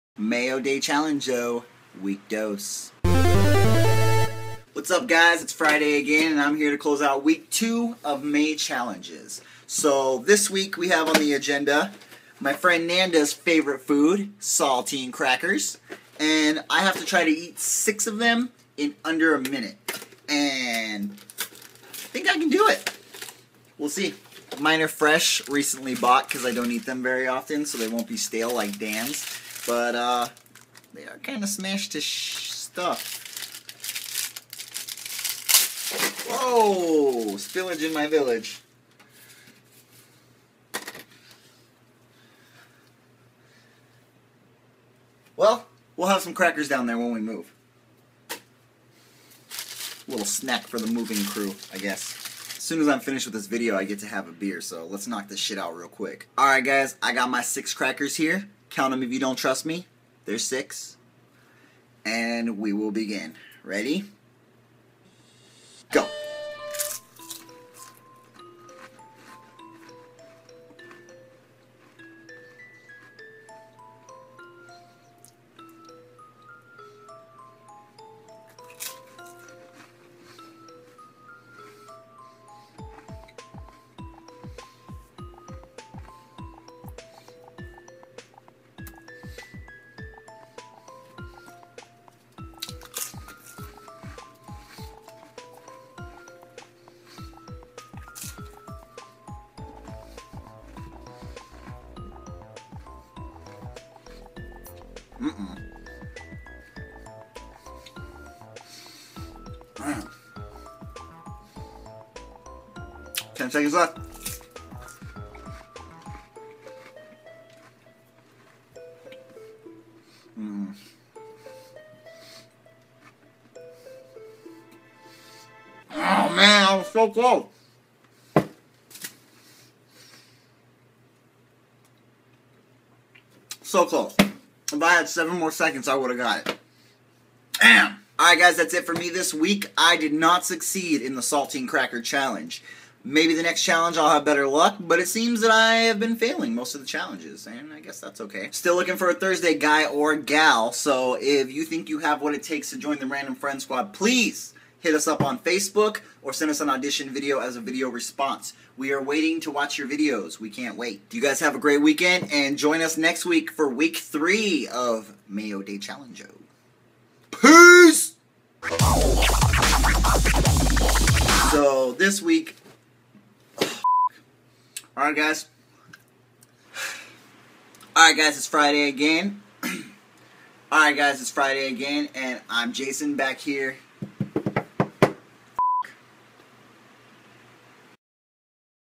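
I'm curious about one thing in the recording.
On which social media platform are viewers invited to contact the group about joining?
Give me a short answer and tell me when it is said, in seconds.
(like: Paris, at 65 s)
Facebook, at 155 s.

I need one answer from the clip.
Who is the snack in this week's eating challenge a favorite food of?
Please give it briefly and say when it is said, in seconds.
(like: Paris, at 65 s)
Nanda, at 12 s.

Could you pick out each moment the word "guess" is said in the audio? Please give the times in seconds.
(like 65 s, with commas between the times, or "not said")
51 s, 147 s.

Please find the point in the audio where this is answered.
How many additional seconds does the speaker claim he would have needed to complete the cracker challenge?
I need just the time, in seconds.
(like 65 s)
135 s.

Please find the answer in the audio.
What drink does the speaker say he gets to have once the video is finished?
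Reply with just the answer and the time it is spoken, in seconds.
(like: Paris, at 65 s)
Beer, at 54 s.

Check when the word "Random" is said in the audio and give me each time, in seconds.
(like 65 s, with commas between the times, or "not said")
153 s.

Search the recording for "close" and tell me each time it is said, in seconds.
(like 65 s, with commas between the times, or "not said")
6 s, 127 s, 133 s.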